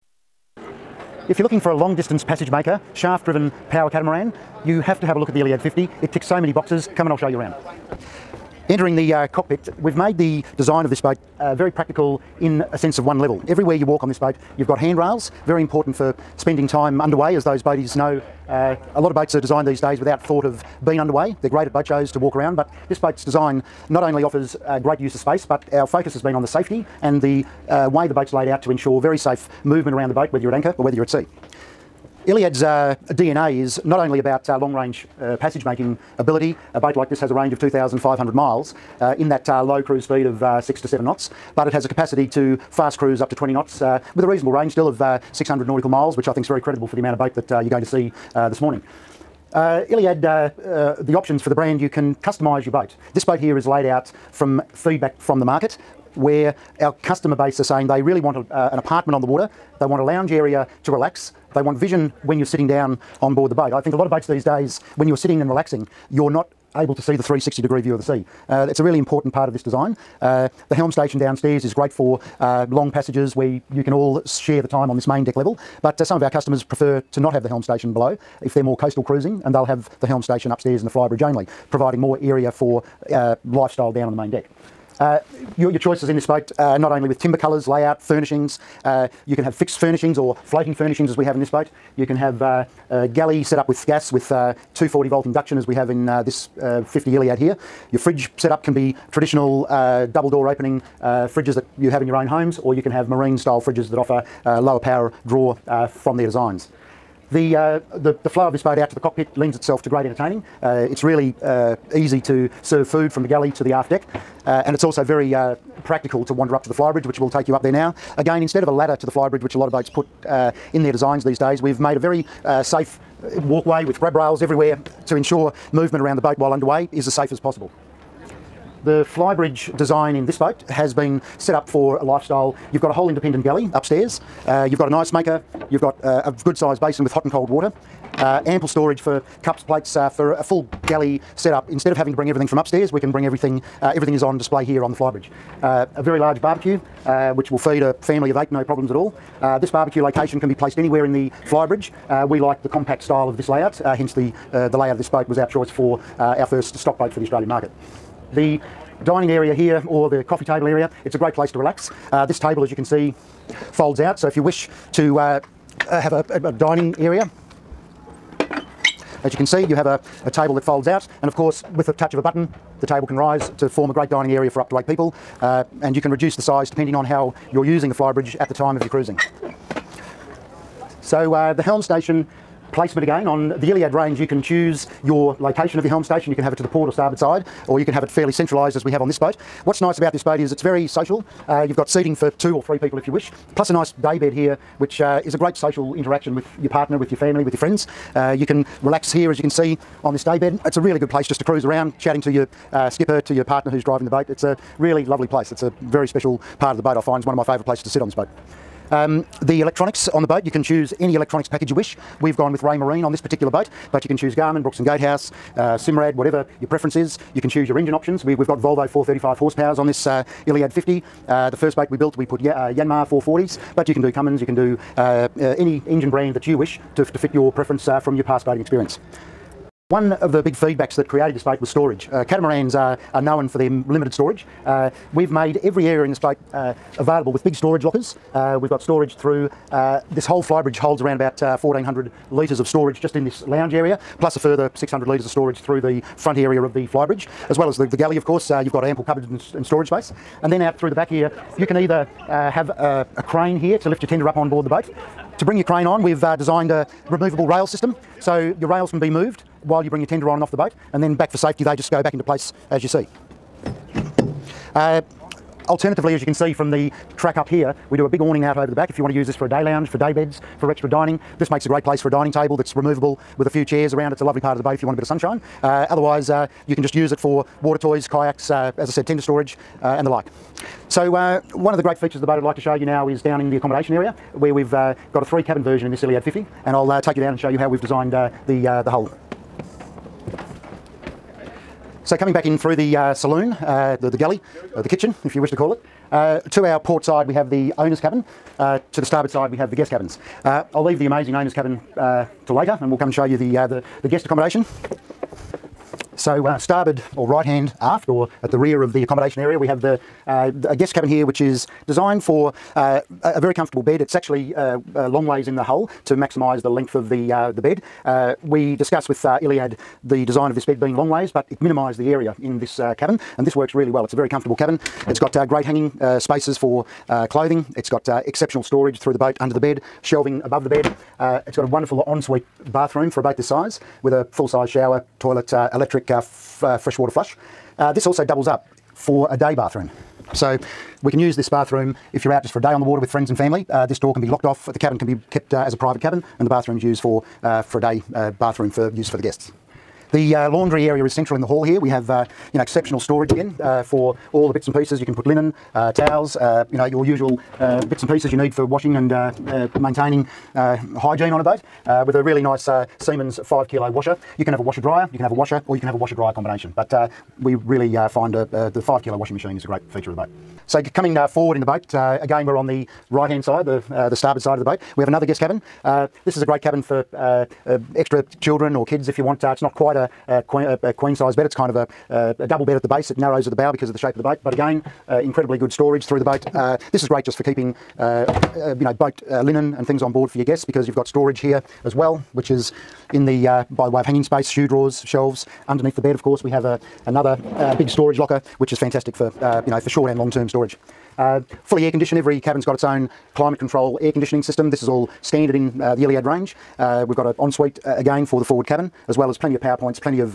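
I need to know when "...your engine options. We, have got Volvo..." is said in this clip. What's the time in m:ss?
3:37.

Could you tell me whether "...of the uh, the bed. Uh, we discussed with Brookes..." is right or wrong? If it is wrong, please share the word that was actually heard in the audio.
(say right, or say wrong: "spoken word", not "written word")
wrong: "Iliad", not "Brookes".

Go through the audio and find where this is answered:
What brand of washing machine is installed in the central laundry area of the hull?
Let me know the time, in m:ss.
6:02.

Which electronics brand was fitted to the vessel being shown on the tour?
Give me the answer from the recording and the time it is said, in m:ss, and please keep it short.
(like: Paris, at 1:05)
Raymarine, at 3:32.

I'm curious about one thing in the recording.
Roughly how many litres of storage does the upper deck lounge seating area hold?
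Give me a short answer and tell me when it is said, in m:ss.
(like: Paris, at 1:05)
1400 litres, at 4:01.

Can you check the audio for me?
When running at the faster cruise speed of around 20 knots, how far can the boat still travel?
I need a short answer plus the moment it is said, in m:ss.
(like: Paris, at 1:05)
600 nautical miles, at 0:45.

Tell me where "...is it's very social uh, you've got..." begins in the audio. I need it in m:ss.
3:10.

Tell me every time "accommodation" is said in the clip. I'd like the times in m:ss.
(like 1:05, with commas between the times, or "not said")
4:43, 5:04, 5:09.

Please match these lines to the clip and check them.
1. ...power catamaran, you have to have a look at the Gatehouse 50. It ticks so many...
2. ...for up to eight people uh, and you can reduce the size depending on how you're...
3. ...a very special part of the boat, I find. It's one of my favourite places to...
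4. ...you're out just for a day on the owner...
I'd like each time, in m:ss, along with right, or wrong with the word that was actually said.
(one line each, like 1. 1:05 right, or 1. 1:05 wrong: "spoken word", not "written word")
1. 0:03 wrong: "Iliad", not "Gatehouse"
2. 2:54 right
3. 3:25 right
4. 5:42 wrong: "water", not "owner".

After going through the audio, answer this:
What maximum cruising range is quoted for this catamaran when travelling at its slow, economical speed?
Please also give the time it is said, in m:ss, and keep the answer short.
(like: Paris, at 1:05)
2,500 miles, at 0:37.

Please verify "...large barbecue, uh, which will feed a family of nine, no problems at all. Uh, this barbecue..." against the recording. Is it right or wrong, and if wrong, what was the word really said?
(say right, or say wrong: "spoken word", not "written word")
wrong: "eight", not "nine".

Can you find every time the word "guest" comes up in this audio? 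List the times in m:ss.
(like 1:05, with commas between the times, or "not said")
4:59, 5:04, 5:10, 5:49, 6:15, 6:30.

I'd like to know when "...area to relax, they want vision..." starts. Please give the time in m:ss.
1:00.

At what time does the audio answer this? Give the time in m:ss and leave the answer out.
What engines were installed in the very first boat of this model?
3:42.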